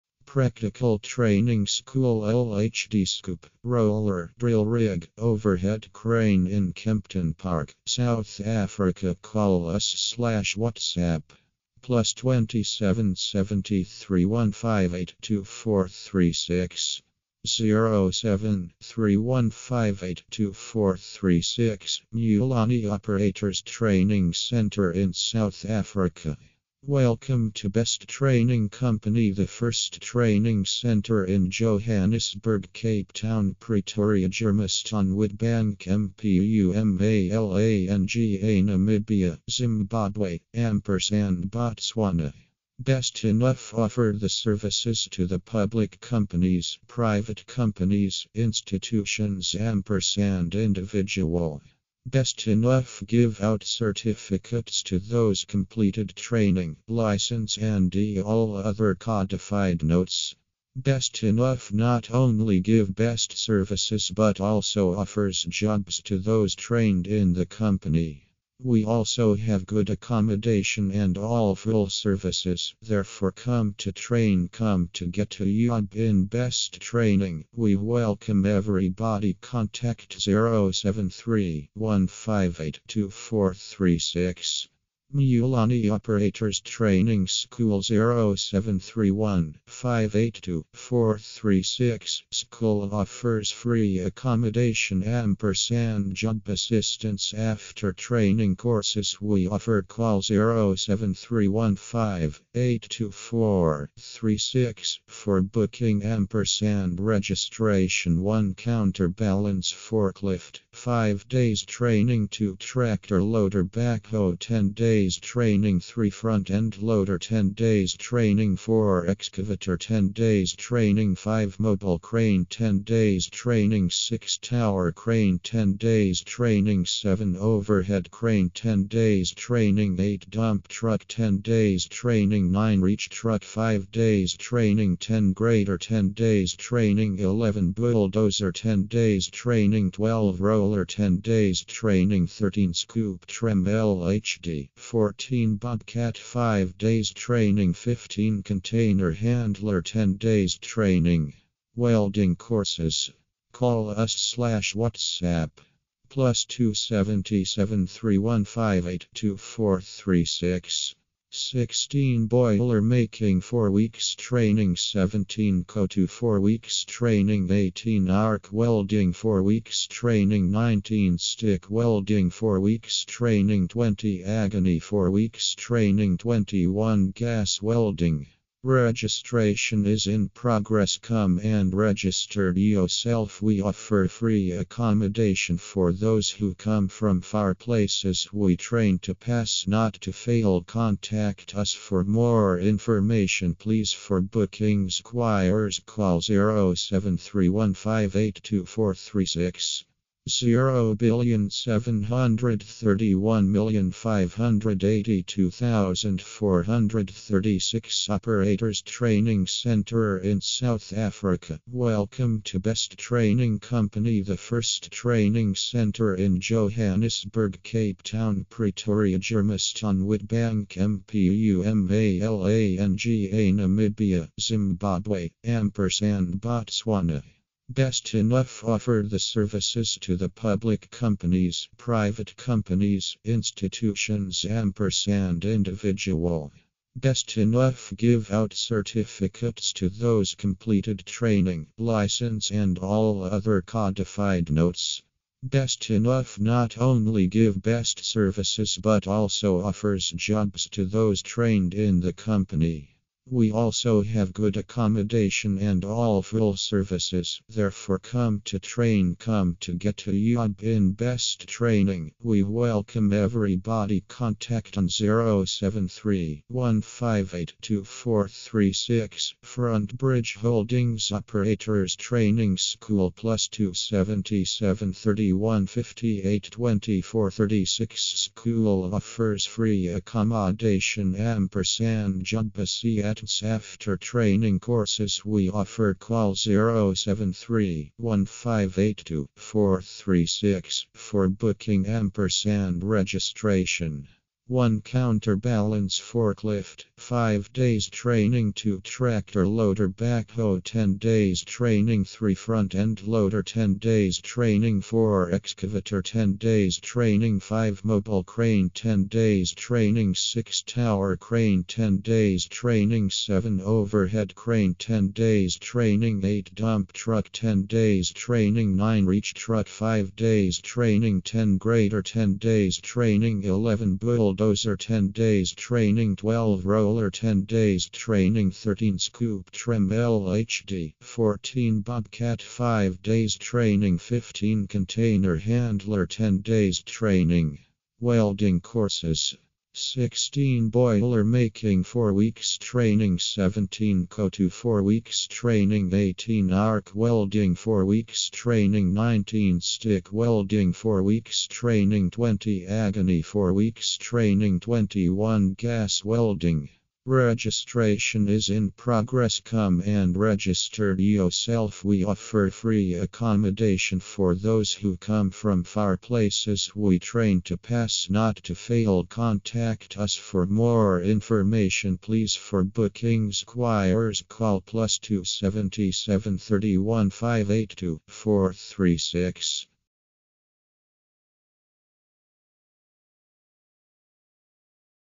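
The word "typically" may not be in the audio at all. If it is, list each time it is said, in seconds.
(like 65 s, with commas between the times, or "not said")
not said.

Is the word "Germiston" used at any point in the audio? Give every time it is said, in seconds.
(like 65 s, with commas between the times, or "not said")
34 s, 219 s.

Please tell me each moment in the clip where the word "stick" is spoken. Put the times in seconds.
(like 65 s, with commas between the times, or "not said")
171 s, 349 s.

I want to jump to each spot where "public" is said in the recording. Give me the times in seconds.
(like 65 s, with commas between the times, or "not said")
45 s, 230 s.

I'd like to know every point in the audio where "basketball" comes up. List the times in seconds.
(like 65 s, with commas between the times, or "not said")
not said.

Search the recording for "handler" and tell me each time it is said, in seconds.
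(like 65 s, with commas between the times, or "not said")
149 s, 335 s.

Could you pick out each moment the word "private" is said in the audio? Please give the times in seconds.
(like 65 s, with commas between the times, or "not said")
46 s, 231 s.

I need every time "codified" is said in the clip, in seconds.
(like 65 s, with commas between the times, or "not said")
58 s, 243 s.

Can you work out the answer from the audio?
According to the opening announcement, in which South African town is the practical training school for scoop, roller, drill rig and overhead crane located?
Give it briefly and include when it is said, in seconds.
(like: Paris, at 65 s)
Kempton Park, at 6 s.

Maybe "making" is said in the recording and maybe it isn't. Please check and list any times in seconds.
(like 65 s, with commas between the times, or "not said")
162 s, 341 s.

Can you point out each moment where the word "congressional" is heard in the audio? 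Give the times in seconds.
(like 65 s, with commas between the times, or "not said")
not said.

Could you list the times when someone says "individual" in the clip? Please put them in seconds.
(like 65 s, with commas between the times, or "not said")
50 s, 235 s.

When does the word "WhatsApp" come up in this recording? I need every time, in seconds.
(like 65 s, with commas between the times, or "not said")
10 s, 154 s.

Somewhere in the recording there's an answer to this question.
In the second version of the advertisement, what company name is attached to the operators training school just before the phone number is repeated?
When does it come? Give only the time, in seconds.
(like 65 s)
269 s.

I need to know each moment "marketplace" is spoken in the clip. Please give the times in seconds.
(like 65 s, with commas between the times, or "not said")
not said.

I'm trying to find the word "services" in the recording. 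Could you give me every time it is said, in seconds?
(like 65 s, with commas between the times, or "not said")
44 s, 63 s, 71 s, 229 s, 248 s, 256 s.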